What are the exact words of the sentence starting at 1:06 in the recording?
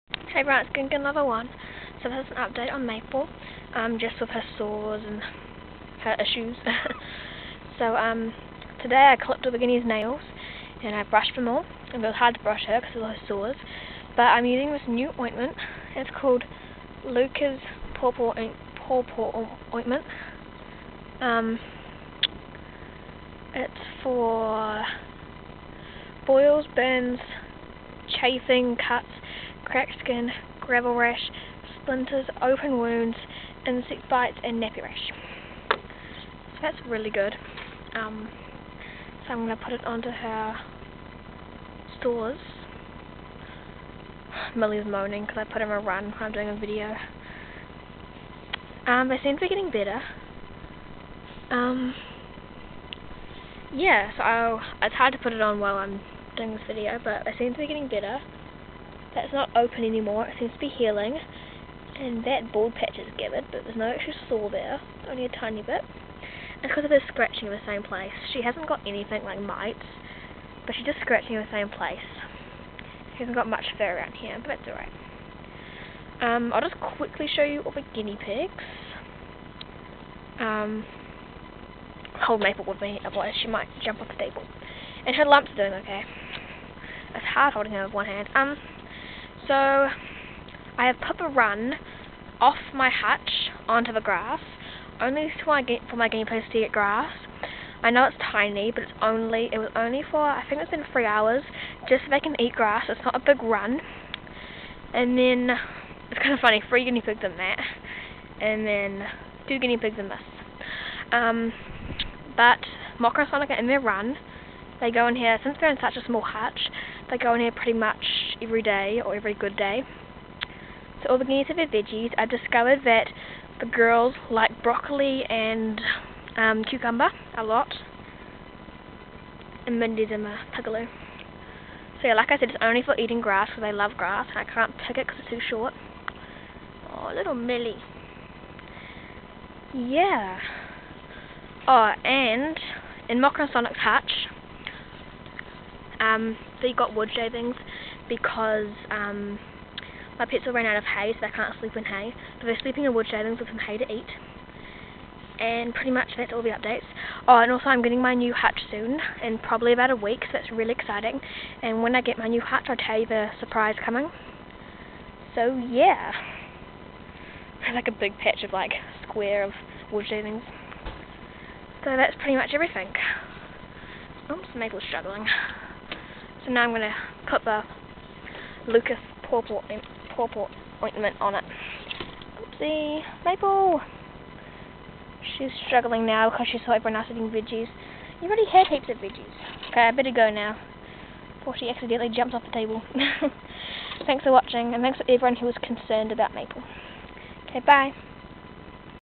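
And because of her scratching in the same place.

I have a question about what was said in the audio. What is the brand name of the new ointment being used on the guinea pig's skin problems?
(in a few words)
Lucas Papaw.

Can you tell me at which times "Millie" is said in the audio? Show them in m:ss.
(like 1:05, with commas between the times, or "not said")
0:44, 2:17.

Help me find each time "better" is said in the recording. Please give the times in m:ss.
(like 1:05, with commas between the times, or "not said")
0:49, 0:57, 3:09.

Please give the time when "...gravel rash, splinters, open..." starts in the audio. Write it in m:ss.
0:30.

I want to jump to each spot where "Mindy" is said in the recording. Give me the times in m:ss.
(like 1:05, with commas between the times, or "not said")
2:09.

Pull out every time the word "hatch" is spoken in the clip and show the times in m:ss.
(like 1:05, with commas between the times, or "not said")
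1:32, 1:56.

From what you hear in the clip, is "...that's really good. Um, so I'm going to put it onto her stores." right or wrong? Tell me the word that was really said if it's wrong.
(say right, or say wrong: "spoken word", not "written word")
right.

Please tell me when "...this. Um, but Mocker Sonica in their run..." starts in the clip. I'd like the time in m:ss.
1:50.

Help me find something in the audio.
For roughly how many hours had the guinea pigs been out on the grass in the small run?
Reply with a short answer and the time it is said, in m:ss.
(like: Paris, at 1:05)
3, at 1:40.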